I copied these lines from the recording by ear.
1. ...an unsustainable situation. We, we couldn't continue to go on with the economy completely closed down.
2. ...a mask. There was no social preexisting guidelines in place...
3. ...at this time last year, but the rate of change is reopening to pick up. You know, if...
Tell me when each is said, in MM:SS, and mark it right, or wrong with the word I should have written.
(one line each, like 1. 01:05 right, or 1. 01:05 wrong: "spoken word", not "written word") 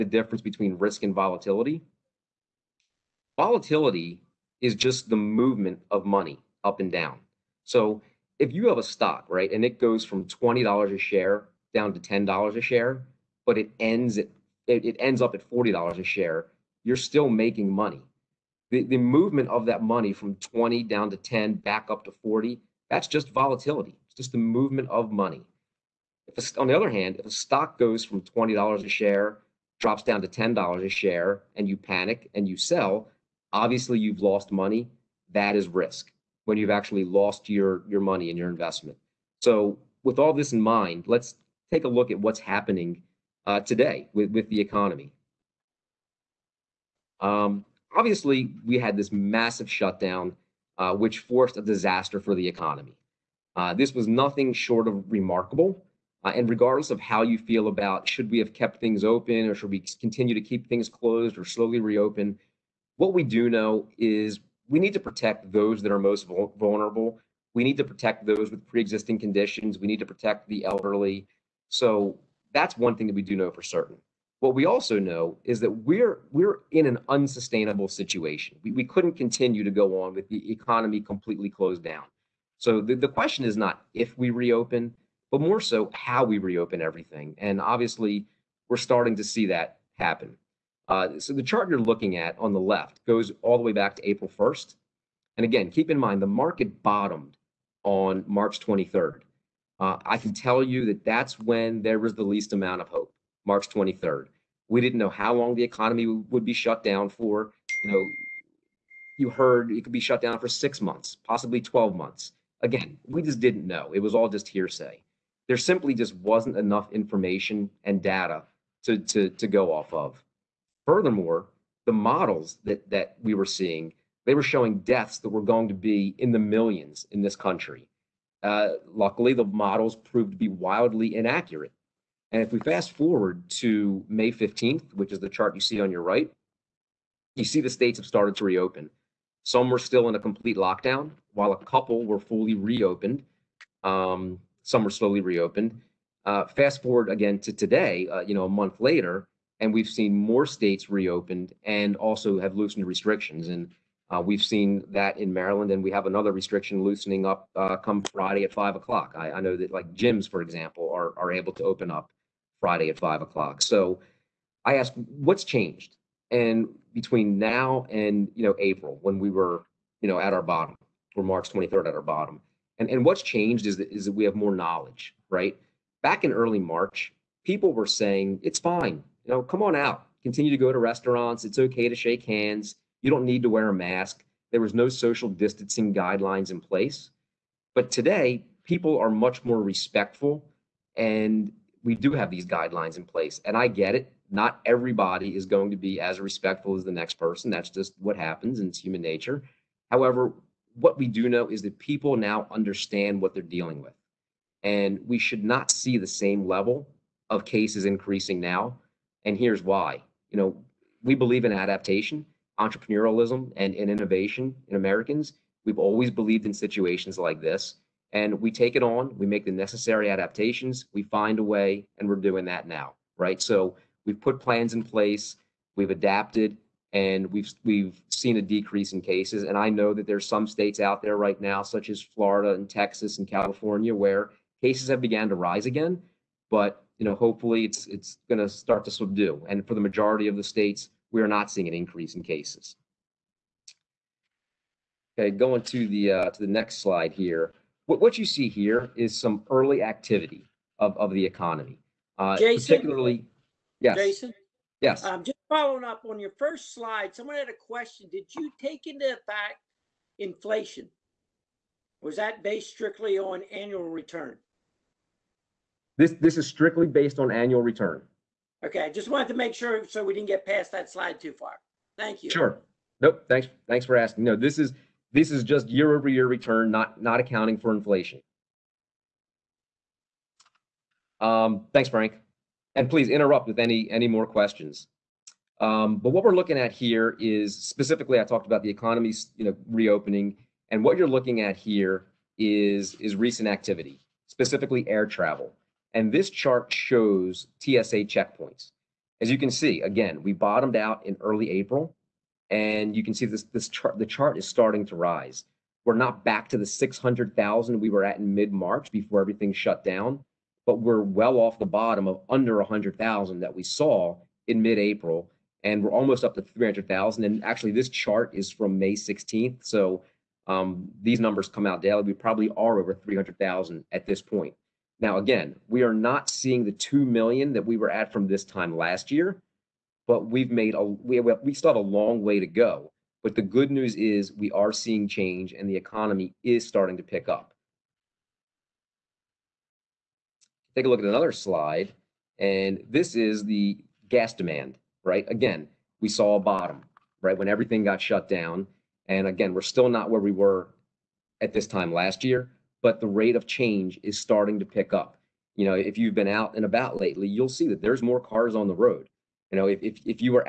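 1. 01:16 right
2. 03:03 wrong: "distancing", not "preexisting"
3. 05:51 wrong: "starting", not "reopening".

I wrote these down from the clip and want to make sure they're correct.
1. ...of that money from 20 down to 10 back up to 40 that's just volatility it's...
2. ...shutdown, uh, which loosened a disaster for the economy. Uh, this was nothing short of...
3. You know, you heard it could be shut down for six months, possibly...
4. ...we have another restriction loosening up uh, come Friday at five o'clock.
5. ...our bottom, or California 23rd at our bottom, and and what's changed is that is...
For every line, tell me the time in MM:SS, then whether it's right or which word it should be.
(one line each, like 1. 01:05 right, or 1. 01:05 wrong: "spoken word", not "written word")
1. 00:19 right
2. 00:49 wrong: "forced", not "loosened"
3. 01:47 right
4. 02:35 right
5. 02:50 wrong: "March", not "California".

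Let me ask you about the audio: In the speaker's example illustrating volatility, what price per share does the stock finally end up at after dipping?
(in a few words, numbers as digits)
$40.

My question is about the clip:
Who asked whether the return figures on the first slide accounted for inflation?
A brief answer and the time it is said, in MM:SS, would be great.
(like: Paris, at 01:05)
Frank, at 04:41.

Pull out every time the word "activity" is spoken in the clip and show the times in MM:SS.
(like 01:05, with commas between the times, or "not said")
04:09, 04:53.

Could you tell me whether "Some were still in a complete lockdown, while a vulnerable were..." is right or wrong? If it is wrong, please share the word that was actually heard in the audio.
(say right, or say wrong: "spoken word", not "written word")
wrong: "couple", not "vulnerable".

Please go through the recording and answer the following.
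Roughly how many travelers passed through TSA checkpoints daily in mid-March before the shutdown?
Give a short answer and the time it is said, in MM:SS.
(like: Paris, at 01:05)
600,000, at 05:06.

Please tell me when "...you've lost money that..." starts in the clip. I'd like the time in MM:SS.
00:33.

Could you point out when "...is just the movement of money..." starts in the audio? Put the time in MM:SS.
00:04.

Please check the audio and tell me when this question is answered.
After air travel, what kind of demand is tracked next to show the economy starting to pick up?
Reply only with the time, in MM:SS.
05:44.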